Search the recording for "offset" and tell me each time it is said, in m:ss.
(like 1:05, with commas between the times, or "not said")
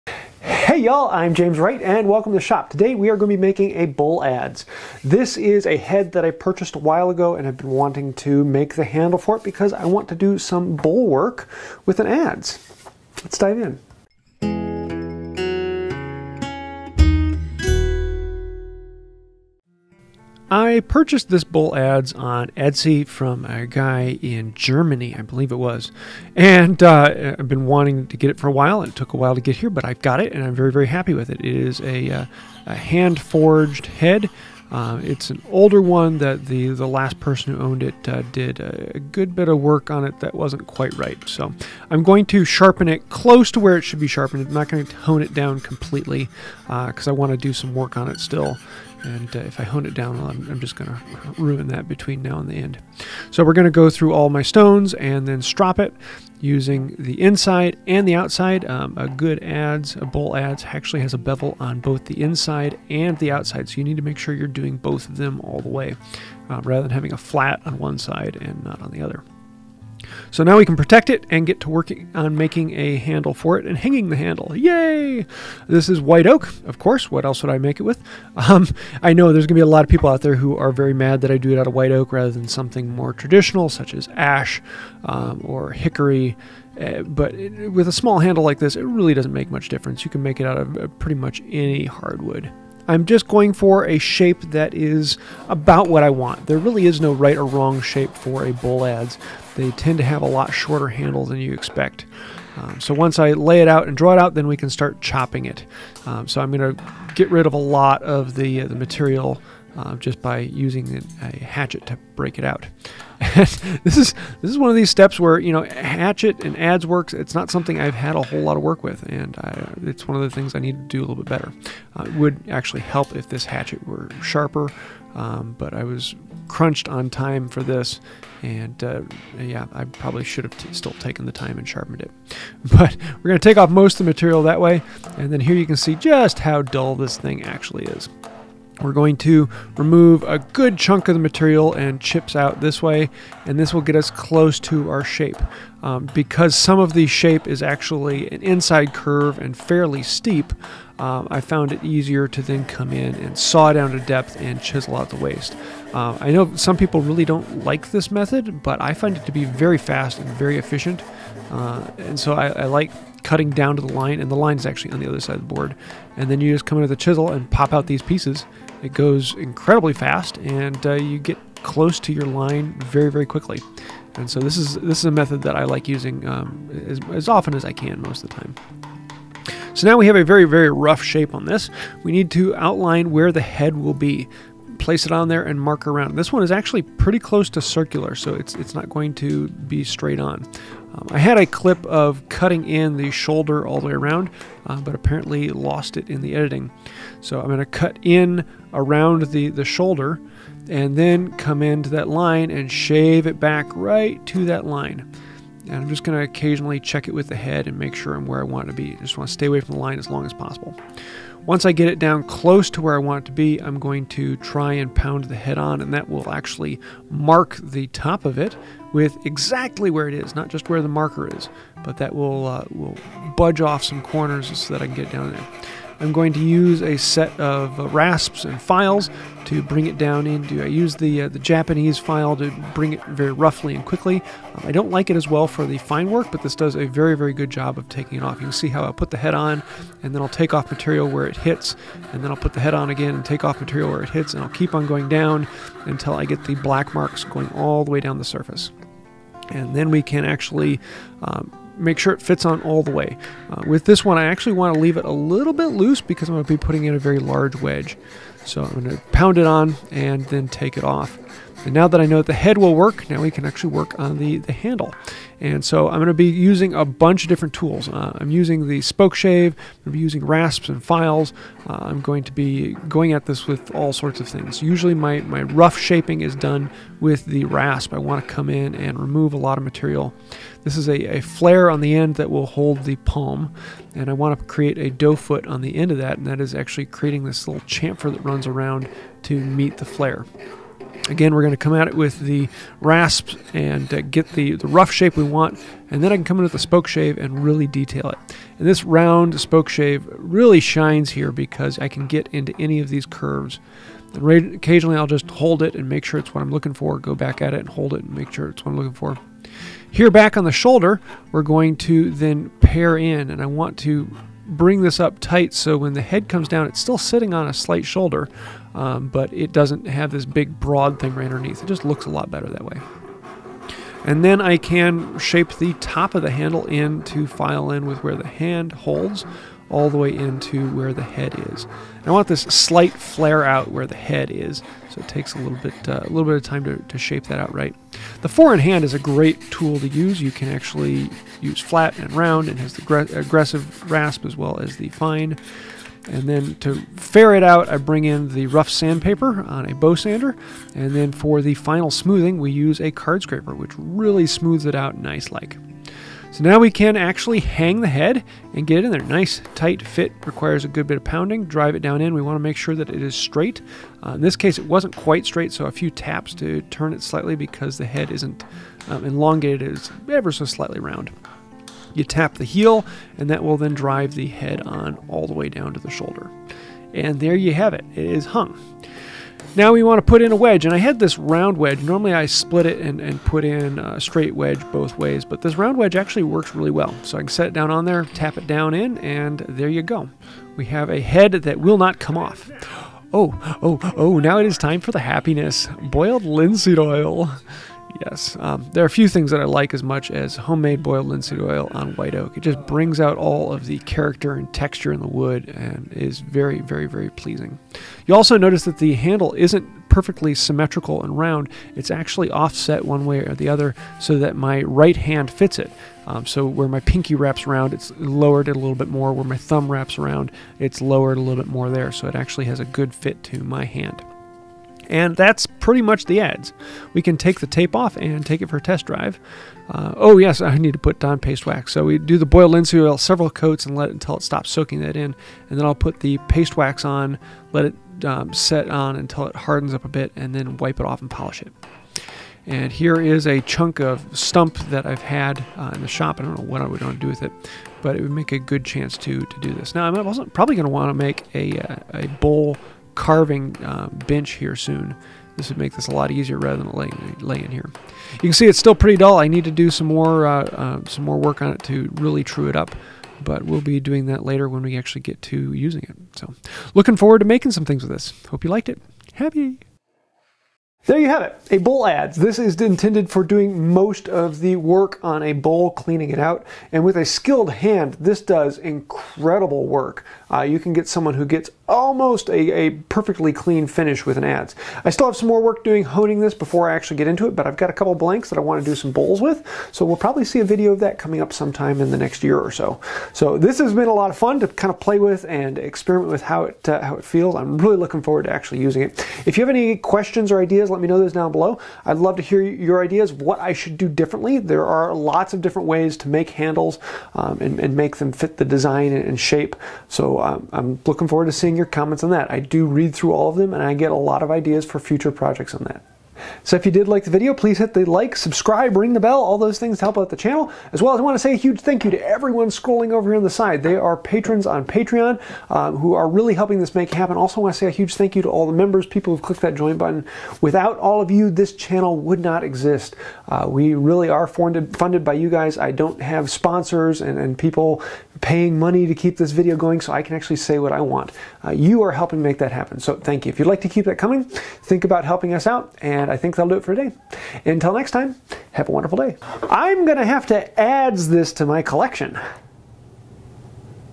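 6:52.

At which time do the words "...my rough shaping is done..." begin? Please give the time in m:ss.
4:35.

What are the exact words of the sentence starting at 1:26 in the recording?
Uh, but it, with a small handle like this, it really doesn't make much difference.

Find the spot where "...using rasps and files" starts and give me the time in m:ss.
4:29.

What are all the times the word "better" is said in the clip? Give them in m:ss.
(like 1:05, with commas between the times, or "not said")
2:01, 5:22.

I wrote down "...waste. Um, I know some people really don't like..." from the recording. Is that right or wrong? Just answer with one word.
right.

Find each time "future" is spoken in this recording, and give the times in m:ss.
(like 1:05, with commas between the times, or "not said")
8:34.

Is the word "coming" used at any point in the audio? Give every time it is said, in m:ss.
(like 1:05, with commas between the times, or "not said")
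8:10, 9:03.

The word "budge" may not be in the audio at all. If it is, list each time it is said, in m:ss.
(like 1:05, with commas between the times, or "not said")
3:43.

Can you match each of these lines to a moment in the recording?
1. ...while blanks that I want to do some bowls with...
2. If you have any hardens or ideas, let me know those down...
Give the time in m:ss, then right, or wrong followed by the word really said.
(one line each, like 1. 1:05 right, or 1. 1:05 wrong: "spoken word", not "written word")
1. 8:07 wrong: "couple", not "while"
2. 8:19 wrong: "questions", not "hardens".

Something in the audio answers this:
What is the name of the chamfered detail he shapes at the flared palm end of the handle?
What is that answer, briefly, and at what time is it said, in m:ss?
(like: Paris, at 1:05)
Doe foot, at 4:44.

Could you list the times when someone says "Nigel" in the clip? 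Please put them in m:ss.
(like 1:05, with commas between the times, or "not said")
not said.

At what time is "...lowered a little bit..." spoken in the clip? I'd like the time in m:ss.
7:00.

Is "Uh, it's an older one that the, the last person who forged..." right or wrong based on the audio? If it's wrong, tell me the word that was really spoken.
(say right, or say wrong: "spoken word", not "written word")
wrong: "owned", not "forged".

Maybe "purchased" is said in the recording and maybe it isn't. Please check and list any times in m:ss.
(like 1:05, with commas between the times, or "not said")
0:06, 0:20.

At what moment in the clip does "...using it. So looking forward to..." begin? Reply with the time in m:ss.
7:45.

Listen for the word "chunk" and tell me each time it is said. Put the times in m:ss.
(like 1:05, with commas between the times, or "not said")
2:20, 7:23.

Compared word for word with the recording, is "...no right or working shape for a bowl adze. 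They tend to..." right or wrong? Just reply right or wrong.
wrong.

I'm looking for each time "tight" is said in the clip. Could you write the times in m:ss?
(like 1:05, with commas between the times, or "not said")
5:15, 5:59.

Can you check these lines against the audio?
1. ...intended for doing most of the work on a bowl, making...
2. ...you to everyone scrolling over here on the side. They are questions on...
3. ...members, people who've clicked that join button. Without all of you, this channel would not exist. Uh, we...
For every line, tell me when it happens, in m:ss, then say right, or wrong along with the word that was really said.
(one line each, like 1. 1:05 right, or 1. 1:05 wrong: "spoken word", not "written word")
1. 7:52 wrong: "cleaning", not "making"
2. 8:41 wrong: "patrons", not "questions"
3. 8:48 right.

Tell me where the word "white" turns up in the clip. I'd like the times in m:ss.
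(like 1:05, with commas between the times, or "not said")
1:16, 1:21, 6:41.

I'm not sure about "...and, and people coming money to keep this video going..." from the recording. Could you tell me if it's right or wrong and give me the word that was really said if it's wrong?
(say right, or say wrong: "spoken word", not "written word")
wrong: "paying", not "coming".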